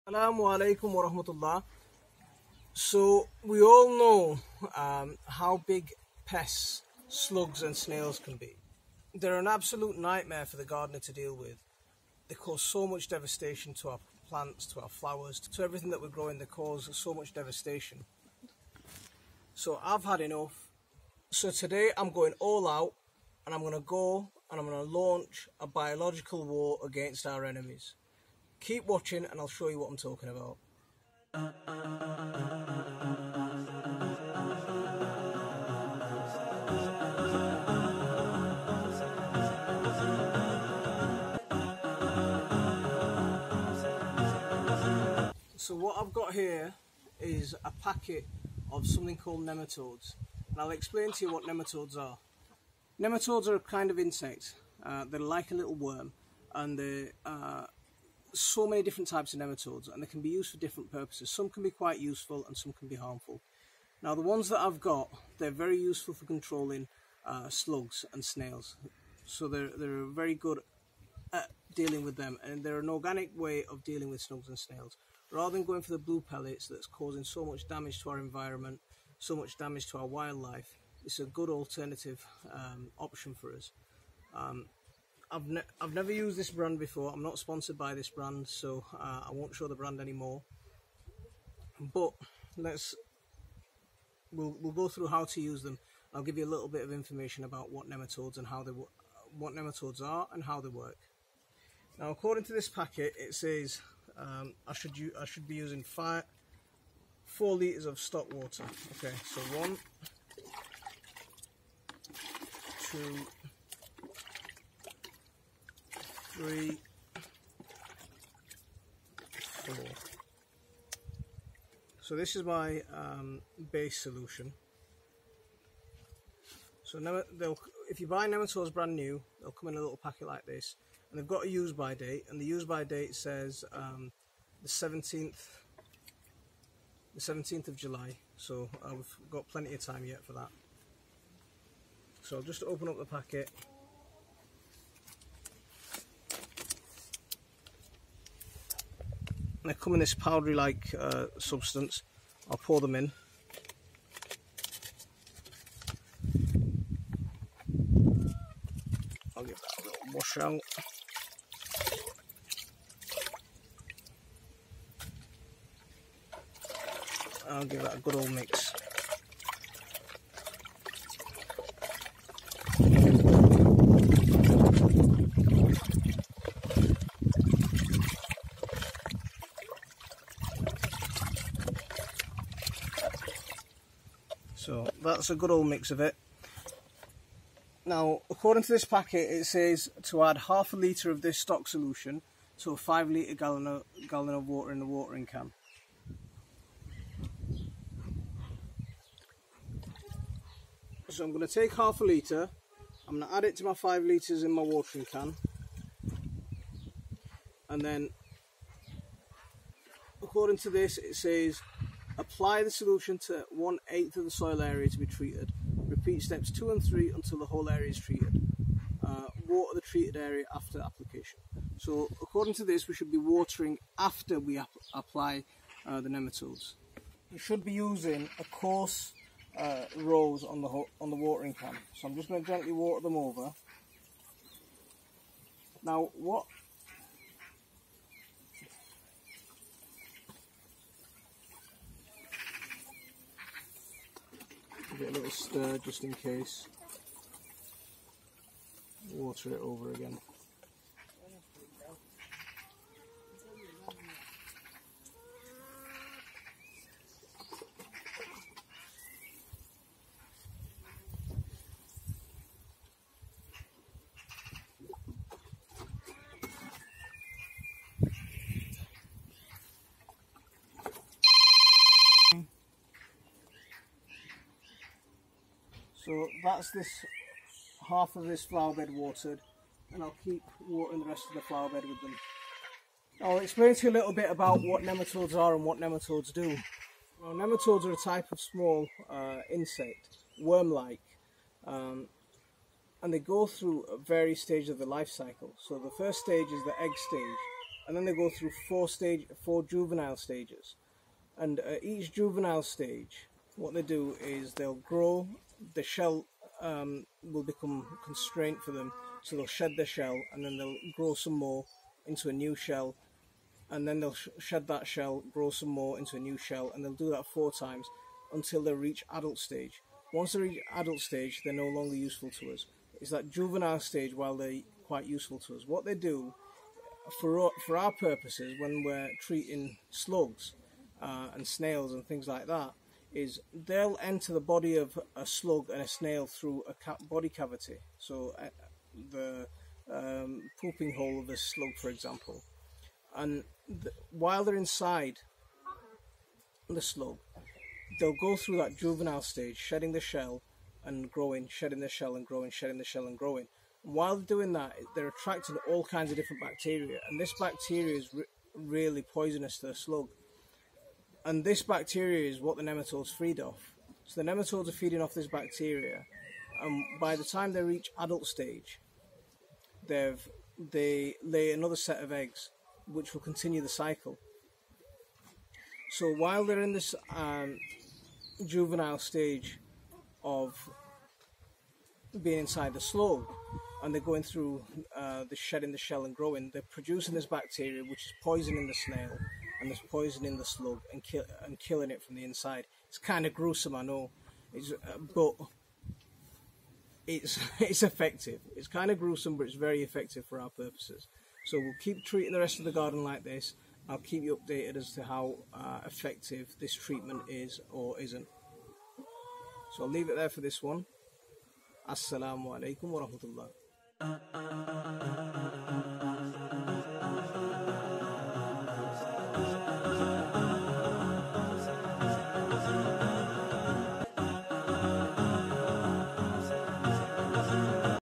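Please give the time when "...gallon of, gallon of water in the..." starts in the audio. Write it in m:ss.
3:13.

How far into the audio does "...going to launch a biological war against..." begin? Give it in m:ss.
0:24.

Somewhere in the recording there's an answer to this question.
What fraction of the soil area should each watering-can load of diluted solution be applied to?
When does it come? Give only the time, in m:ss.
3:33.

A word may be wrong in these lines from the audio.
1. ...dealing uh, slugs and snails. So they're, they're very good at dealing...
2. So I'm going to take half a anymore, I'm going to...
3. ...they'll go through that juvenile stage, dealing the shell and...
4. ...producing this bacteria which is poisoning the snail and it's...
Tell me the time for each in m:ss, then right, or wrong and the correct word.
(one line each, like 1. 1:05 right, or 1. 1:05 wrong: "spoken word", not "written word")
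1. 1:06 wrong: "controlling", not "dealing"
2. 3:21 wrong: "litre", not "anymore"
3. 5:47 wrong: "shedding", not "dealing"
4. 6:26 right.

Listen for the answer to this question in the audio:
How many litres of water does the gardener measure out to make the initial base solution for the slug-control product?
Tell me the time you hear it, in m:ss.
1:47.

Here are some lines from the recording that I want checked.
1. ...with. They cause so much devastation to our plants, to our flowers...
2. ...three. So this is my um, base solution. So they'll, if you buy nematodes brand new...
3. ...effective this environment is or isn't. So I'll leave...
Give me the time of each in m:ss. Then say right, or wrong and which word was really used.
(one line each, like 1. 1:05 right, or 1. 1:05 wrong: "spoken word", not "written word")
1. 0:11 right
2. 1:59 wrong: "four", not "three"
3. 6:45 wrong: "treatment", not "environment".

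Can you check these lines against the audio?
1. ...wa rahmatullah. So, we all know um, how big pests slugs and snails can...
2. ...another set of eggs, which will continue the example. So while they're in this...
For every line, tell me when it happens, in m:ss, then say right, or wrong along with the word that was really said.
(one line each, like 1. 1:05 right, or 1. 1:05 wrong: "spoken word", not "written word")
1. 0:00 right
2. 6:11 wrong: "cycle", not "example".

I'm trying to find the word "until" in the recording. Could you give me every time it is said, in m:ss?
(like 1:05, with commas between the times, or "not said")
3:37, 5:18.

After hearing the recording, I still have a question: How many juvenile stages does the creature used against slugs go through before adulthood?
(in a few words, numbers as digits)
4.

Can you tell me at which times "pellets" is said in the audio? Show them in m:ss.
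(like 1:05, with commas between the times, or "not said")
1:16.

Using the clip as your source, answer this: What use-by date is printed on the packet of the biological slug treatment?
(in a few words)
17th of July.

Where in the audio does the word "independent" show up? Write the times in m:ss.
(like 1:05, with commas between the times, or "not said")
not said.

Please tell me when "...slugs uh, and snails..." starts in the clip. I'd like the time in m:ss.
5:29.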